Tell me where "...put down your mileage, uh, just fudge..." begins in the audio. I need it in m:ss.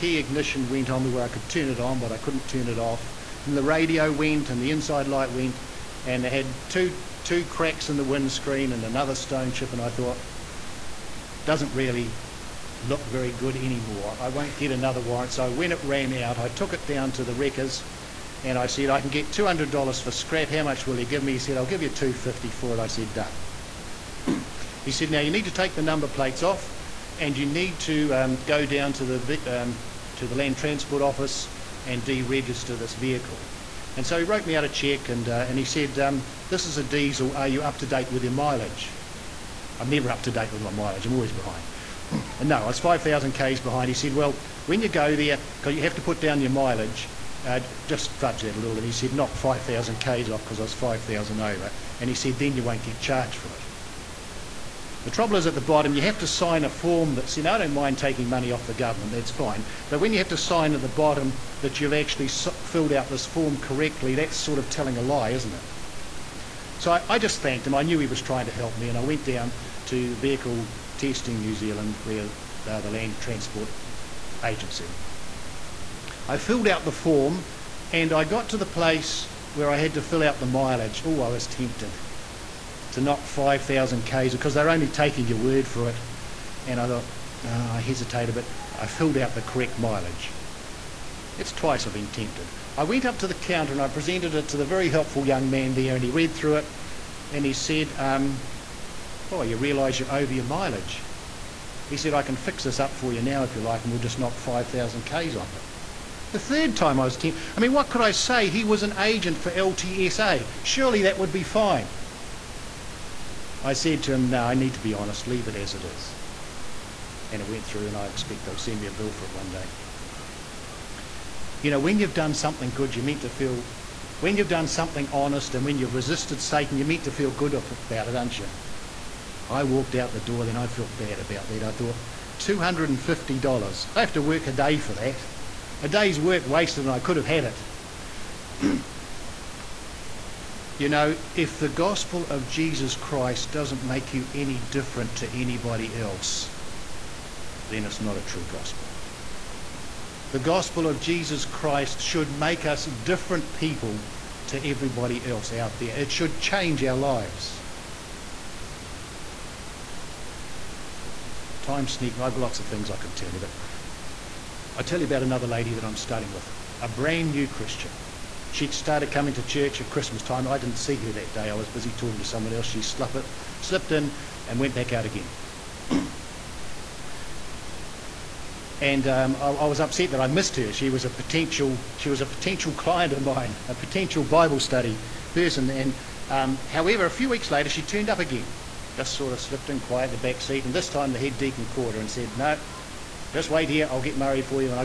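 0:46.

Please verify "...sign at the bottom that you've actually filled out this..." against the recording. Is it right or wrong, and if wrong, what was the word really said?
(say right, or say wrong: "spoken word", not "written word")
right.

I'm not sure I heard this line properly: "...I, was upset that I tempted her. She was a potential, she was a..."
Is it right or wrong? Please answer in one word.
wrong.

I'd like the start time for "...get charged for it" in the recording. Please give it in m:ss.
0:52.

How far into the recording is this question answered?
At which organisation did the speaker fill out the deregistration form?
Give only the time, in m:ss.
1:10.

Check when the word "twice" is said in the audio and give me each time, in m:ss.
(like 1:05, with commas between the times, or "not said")
1:31.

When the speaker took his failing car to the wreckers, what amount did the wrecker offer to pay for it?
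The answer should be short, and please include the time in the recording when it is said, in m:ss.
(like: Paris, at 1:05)
$250, at 0:21.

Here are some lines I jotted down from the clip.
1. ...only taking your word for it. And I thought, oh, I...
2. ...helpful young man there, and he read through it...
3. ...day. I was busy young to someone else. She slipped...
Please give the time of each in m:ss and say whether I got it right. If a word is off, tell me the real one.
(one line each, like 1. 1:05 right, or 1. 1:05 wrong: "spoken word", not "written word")
1. 1:24 right
2. 1:34 right
3. 2:51 wrong: "talking", not "young".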